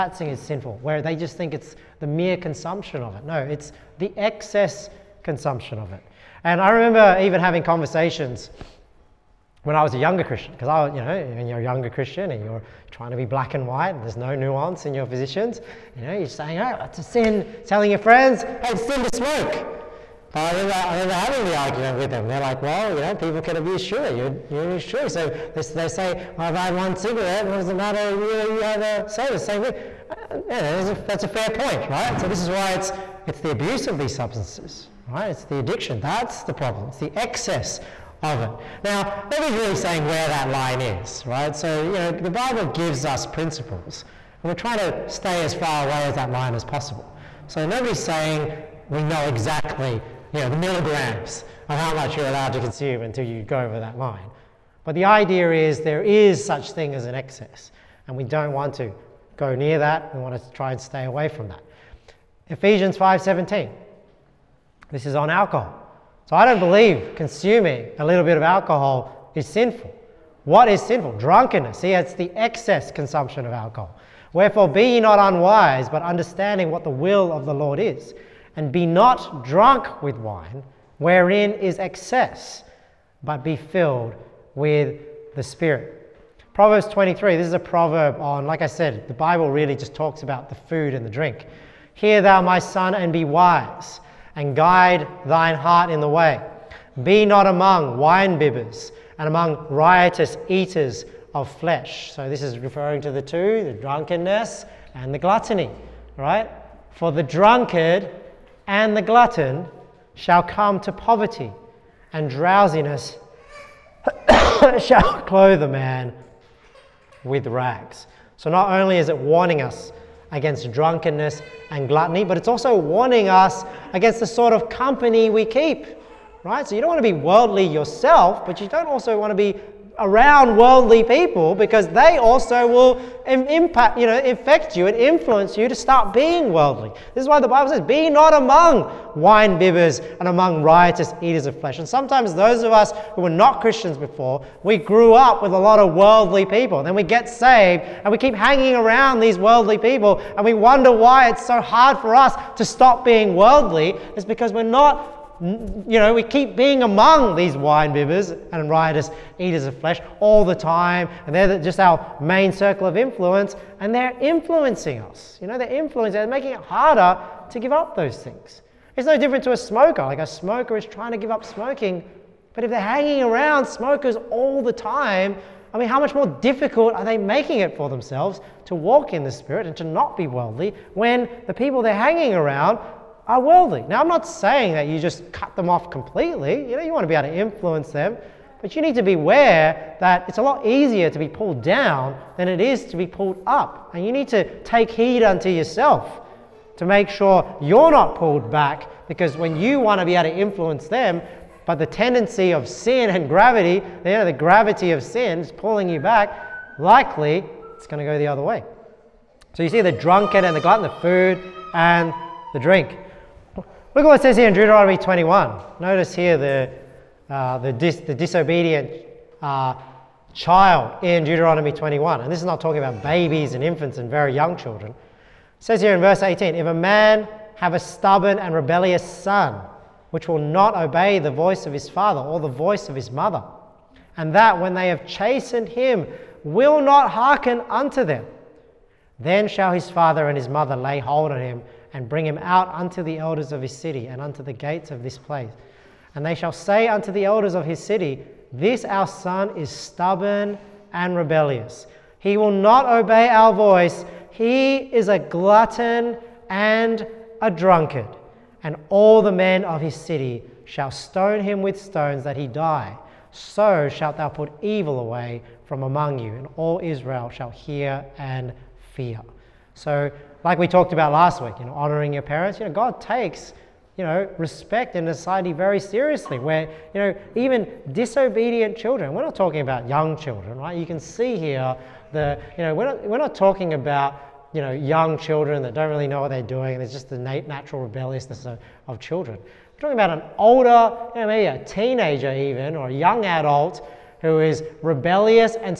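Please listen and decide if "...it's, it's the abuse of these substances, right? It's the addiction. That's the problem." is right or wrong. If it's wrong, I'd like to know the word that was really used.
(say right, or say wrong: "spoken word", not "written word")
right.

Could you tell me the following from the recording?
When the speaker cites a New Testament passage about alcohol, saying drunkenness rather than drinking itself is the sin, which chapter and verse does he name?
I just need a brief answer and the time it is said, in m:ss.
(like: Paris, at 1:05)
Ephesians 5:17, at 1:02.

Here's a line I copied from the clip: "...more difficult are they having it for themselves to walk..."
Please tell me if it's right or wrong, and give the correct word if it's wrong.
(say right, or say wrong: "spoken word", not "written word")
wrong: "making", not "having".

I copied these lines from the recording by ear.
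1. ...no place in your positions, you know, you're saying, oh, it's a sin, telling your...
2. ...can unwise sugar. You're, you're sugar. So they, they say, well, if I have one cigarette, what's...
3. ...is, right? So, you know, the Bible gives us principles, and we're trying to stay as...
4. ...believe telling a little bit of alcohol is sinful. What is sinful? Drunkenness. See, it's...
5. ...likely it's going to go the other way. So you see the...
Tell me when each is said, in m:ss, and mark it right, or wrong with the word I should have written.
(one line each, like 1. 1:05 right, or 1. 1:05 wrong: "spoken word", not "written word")
1. 0:14 wrong: "nuance", not "place"
2. 0:23 wrong: "abuse", not "unwise"
3. 0:40 right
4. 1:06 wrong: "consuming", not "telling"
5. 3:26 right.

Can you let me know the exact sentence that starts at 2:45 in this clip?
You know, they're influencing, they're making it harder to give up those things.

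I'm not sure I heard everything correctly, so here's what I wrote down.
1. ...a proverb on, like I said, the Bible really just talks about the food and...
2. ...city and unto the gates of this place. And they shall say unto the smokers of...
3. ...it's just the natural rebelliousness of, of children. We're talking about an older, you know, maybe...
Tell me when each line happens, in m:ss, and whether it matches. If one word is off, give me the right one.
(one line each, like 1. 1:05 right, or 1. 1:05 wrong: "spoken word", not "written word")
1. 1:27 right
2. 4:03 wrong: "elders", not "smokers"
3. 4:46 right.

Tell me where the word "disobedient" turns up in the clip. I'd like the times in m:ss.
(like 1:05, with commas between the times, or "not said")
3:38, 4:37.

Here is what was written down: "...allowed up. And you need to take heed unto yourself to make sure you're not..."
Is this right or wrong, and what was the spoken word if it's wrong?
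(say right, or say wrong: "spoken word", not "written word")
wrong: "pulled", not "allowed".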